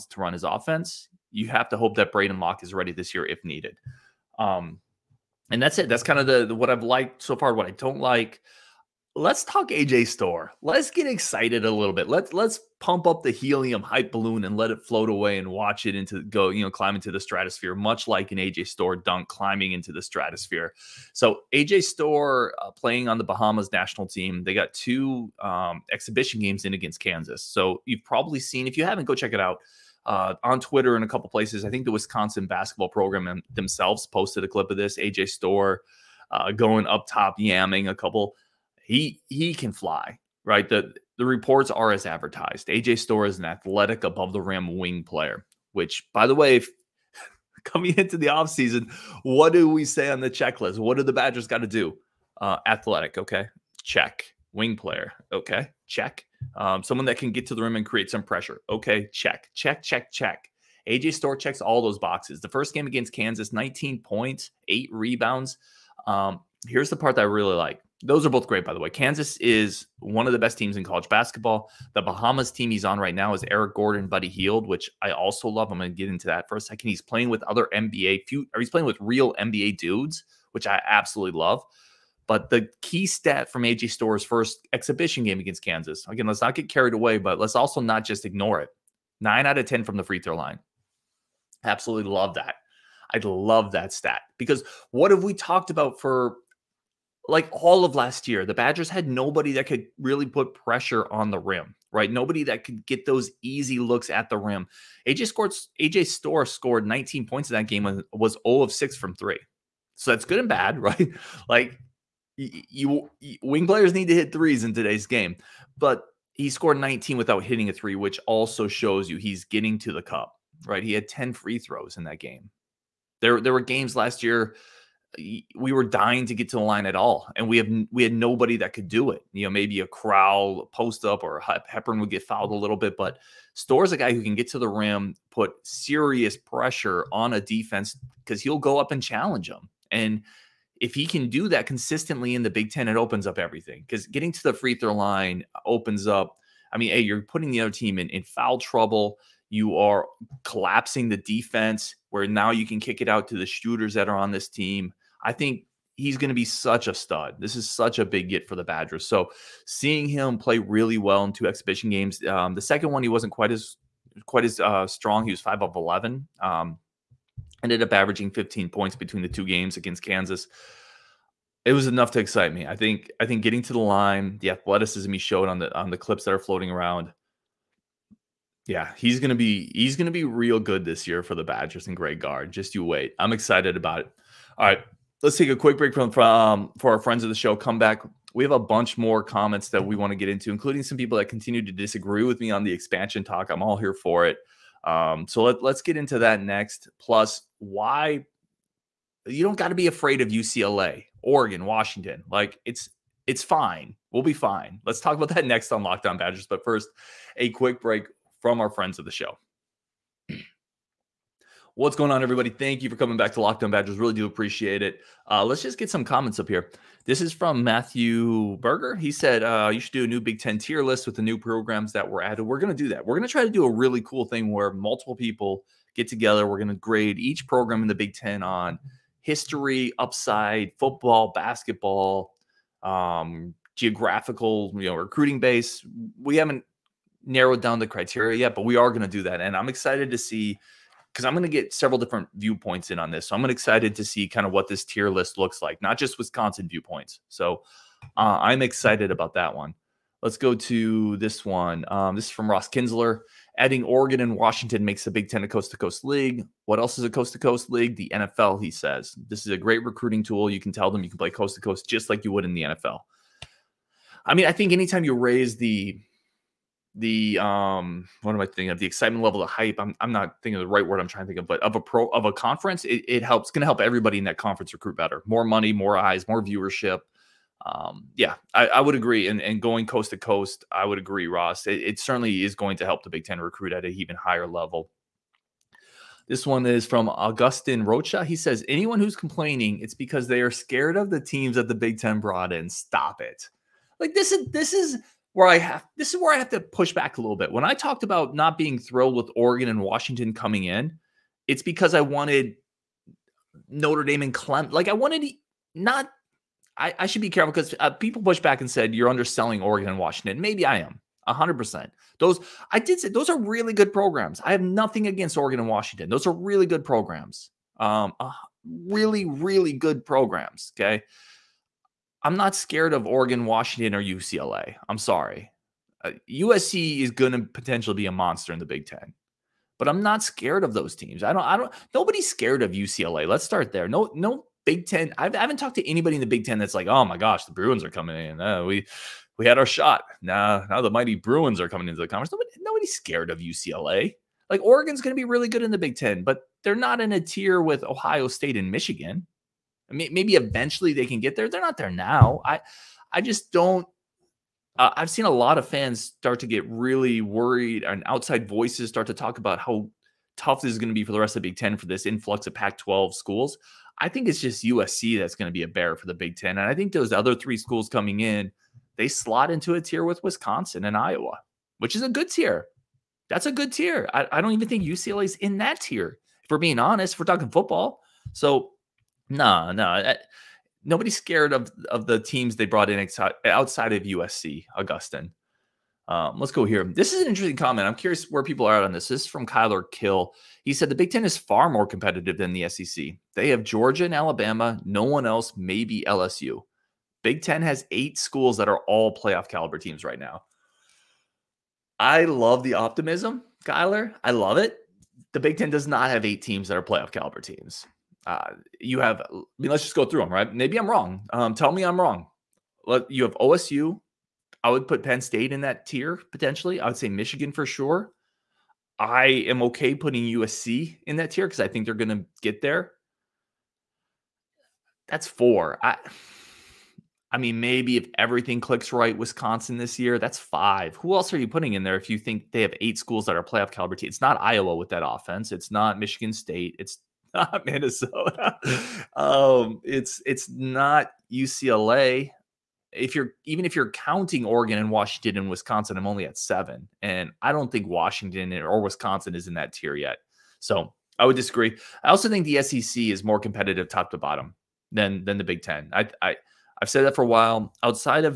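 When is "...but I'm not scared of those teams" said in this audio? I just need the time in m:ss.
5:29.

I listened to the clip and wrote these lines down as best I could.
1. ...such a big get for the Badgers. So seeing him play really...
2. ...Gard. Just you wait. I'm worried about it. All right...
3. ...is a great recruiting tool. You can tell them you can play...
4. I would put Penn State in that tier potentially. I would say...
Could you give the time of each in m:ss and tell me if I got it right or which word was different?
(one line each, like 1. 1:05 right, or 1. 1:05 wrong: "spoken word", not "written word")
1. 2:37 right
2. 3:02 wrong: "excited", not "worried"
3. 4:19 right
4. 6:54 right.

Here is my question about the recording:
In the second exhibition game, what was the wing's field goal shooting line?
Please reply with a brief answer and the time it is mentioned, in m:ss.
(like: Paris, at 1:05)
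5 of 11, at 2:45.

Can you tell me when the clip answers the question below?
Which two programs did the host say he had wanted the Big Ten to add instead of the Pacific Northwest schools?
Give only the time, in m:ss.
5:03.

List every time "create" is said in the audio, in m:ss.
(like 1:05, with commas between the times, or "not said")
0:57.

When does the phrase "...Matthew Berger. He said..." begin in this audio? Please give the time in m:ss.
3:37.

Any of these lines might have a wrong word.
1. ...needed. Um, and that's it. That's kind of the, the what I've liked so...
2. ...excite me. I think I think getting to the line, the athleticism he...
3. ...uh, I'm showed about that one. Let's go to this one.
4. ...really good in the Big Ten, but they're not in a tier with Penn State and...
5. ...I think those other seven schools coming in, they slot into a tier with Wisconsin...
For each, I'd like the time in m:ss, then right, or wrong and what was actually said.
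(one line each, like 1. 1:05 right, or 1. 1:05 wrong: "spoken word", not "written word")
1. 0:03 right
2. 2:52 right
3. 4:08 wrong: "excited", not "showed"
4. 5:45 wrong: "Ohio", not "Penn"
5. 6:06 wrong: "three", not "seven".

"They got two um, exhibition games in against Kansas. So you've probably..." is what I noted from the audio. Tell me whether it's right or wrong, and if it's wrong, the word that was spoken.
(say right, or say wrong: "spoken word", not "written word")
right.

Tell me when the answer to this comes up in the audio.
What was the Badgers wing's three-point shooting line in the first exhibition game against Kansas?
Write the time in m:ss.
1:48.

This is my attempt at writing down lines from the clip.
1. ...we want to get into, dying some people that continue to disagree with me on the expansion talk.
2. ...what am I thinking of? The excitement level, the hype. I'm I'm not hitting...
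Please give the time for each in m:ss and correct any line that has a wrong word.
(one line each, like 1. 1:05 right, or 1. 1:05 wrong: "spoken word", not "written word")
1. 3:09 wrong: "including", not "dying"
2. 4:28 wrong: "thinking", not "hitting".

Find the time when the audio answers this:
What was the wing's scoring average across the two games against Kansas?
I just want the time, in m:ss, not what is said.
2:48.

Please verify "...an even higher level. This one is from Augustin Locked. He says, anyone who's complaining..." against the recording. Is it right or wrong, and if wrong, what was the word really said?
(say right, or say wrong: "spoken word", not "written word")
wrong: "Rocha", not "Locked".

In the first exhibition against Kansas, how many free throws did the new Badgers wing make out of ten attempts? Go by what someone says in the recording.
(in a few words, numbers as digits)
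9.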